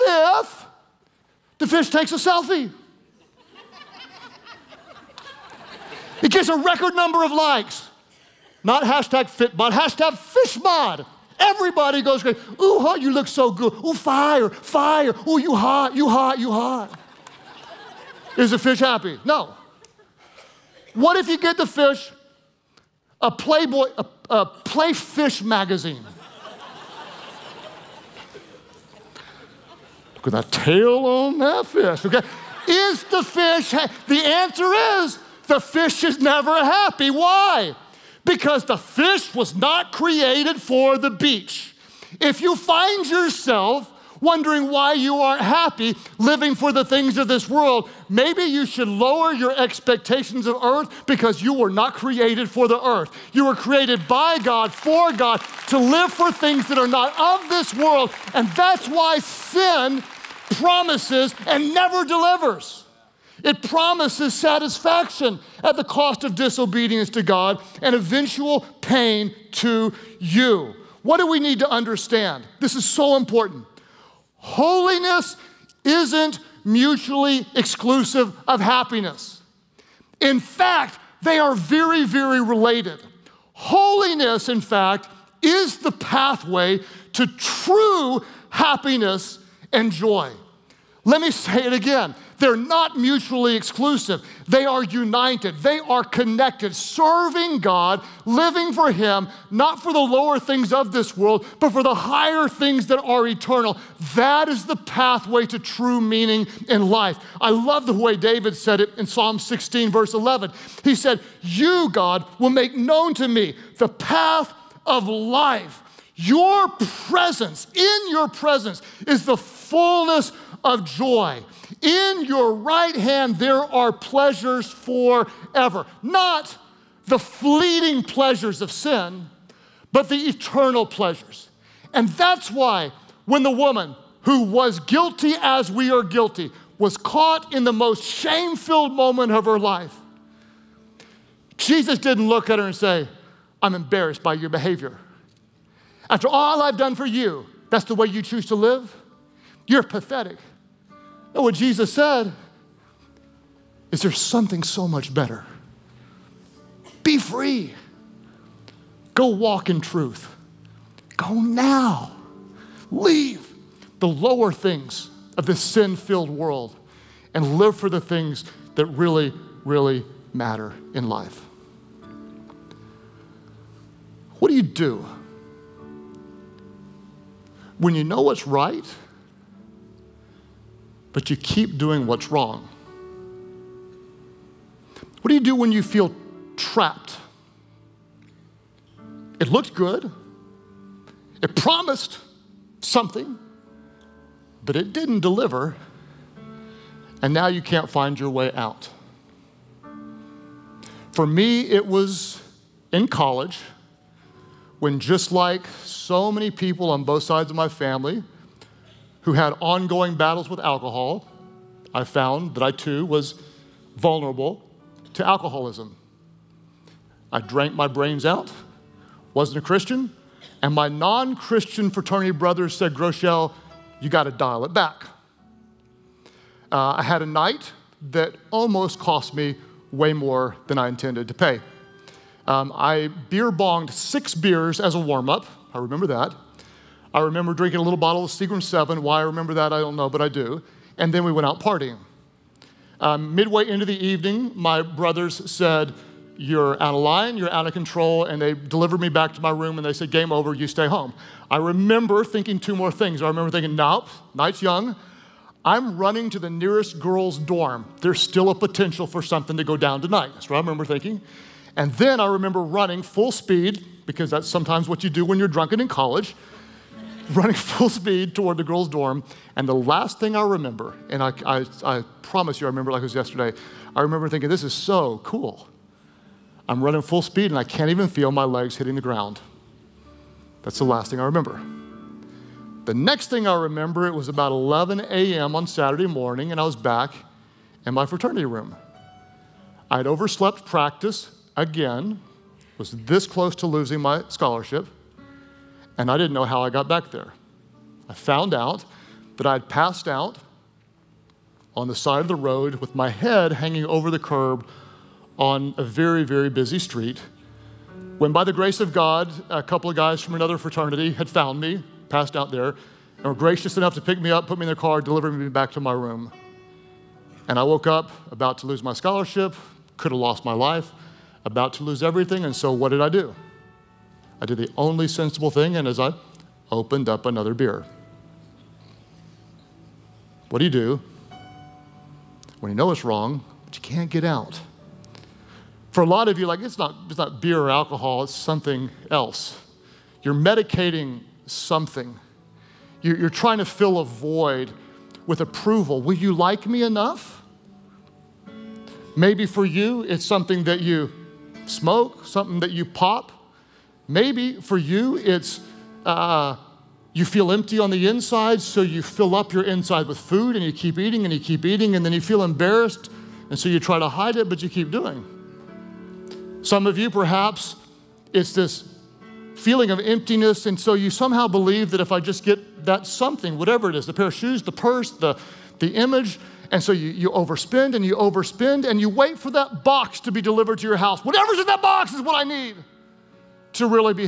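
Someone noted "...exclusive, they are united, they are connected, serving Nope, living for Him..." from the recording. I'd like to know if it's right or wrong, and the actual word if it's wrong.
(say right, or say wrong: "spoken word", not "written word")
wrong: "God", not "Nope".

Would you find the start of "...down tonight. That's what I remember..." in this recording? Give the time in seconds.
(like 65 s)
259 s.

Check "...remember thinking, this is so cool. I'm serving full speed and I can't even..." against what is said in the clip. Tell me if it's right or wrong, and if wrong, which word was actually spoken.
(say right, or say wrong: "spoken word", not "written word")
wrong: "running", not "serving".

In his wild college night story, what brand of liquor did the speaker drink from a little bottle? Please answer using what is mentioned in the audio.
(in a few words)
Seagram 7.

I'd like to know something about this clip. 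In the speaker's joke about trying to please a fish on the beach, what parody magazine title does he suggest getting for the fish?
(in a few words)
Playfish.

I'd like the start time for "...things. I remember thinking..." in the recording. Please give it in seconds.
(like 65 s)
252 s.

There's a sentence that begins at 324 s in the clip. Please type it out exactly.
I did the only sensible thing, and as I opened up another beer.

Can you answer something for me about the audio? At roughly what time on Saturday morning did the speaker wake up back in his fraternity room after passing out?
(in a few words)
11 a.m.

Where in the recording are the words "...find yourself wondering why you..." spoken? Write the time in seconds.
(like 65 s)
42 s.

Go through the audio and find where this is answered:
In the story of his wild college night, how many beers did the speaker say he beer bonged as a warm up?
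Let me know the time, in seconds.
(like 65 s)
233 s.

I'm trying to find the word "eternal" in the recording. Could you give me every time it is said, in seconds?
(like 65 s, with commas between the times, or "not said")
103 s, 130 s.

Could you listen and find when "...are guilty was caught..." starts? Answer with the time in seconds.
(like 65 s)
135 s.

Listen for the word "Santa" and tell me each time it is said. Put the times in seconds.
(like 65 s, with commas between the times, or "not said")
not said.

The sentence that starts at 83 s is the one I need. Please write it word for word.
Holiness, in fact, is the pathway to true happiness and joy.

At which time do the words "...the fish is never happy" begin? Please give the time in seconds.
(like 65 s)
35 s.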